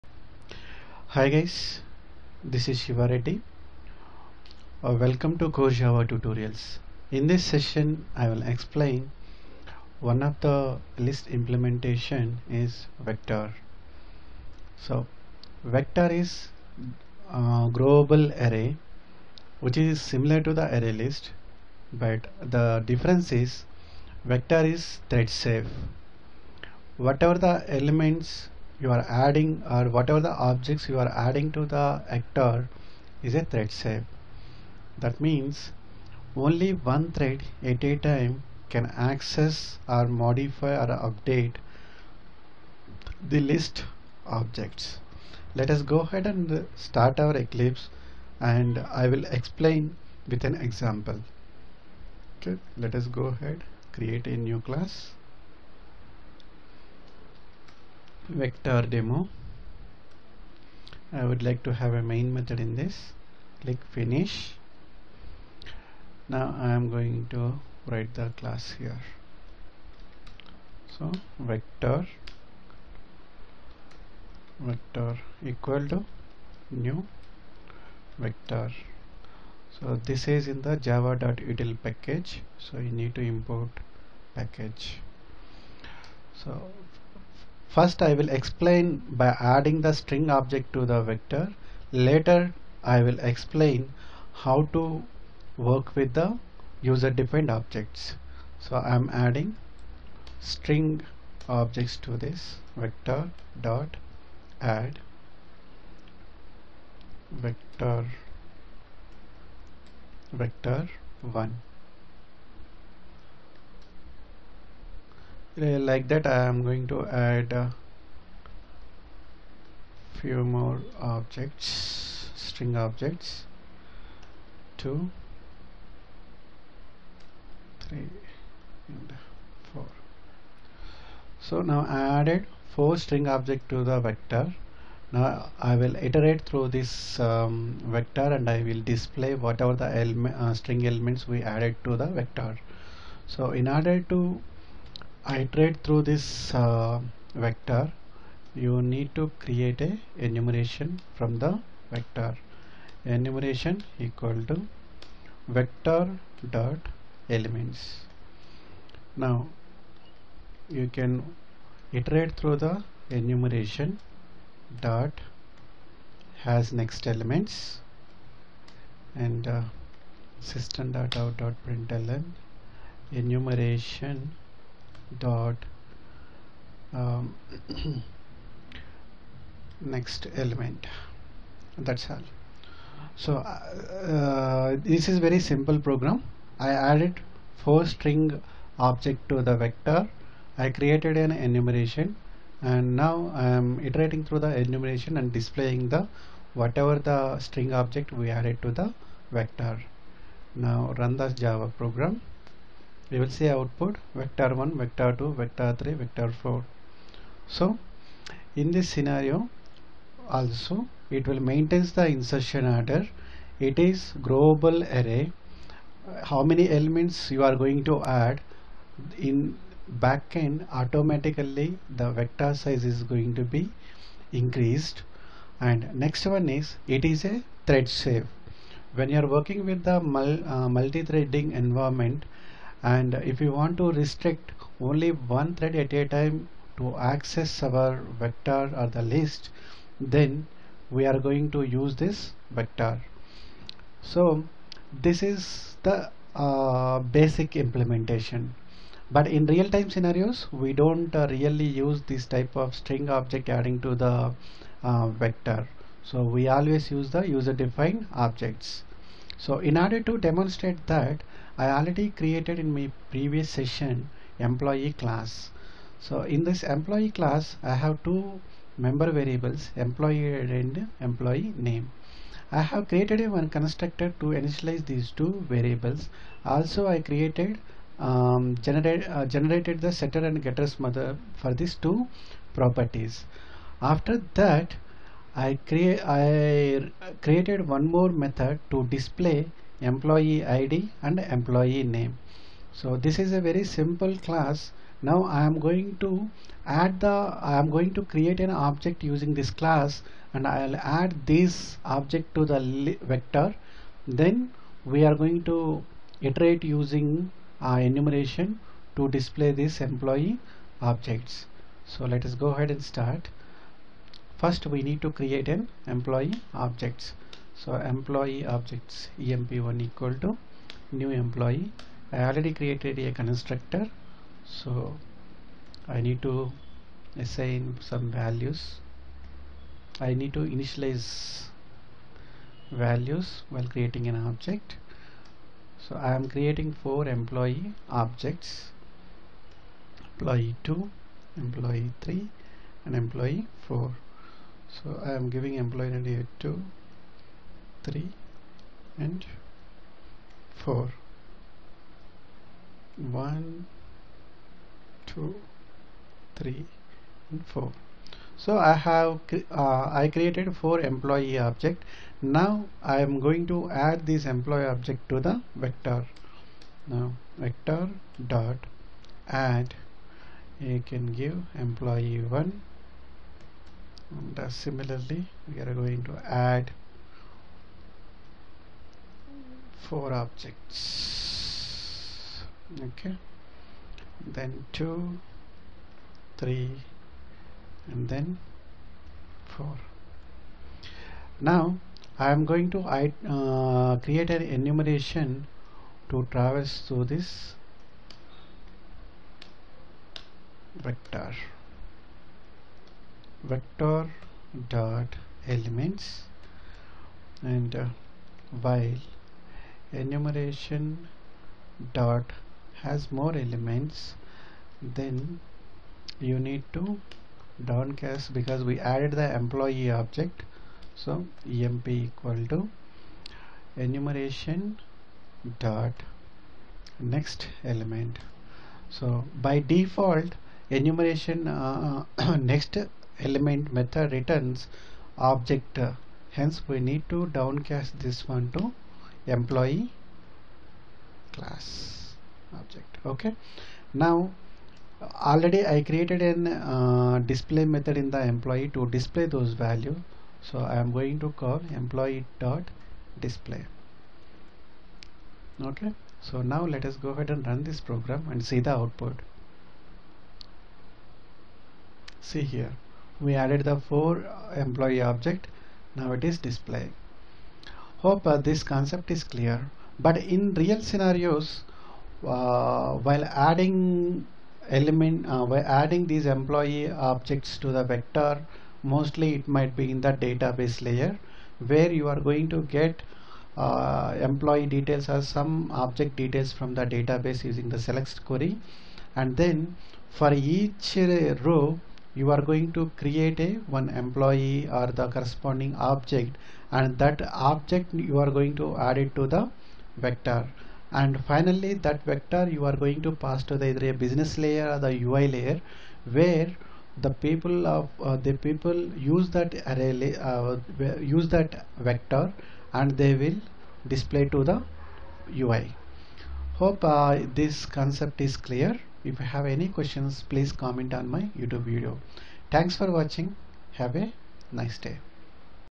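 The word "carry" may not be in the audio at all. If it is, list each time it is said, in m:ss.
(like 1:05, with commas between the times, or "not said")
not said.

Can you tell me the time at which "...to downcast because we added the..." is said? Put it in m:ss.
6:56.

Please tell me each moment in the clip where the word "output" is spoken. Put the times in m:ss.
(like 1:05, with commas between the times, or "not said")
3:23, 7:38.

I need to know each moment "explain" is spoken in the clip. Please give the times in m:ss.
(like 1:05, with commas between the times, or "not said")
0:08, 0:49, 1:28, 1:33.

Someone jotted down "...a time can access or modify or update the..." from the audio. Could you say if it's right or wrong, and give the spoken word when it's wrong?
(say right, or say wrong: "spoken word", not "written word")
right.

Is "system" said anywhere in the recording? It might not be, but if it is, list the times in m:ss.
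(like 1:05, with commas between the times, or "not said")
2:50.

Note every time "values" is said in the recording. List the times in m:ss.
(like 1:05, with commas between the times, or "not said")
5:28, 5:32, 7:29.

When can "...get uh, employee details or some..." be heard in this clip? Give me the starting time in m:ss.
8:02.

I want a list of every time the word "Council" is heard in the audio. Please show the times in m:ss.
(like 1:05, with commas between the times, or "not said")
not said.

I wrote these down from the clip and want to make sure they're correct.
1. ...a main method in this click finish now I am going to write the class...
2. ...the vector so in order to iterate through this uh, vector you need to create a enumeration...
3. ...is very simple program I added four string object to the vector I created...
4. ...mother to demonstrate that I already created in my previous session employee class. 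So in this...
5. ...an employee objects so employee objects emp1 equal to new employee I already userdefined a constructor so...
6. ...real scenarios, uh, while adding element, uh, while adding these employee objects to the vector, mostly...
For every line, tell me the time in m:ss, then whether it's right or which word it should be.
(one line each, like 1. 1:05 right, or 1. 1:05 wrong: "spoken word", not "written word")
1. 1:01 right
2. 2:21 right
3. 3:05 right
4. 4:19 wrong: "order", not "mother"
5. 5:15 wrong: "created", not "userdefined"
6. 7:50 right.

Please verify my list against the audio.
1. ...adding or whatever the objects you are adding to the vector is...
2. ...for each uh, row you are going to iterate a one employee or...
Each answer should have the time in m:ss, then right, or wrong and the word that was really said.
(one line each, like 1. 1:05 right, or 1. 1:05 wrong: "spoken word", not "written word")
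1. 0:29 right
2. 8:10 wrong: "create", not "iterate".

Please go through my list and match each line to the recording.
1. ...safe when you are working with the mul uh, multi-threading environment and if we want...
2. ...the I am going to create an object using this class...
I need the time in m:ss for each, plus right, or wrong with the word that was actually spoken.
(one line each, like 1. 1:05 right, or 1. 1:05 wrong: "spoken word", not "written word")
1. 3:48 right
2. 4:56 right.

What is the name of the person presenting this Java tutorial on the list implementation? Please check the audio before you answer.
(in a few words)
Siva Reddy.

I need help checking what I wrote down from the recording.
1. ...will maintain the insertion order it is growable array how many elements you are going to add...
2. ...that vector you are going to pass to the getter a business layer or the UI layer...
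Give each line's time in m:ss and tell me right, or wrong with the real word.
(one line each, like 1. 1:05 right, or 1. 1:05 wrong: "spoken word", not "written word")
1. 3:31 right
2. 8:21 wrong: "either", not "getter".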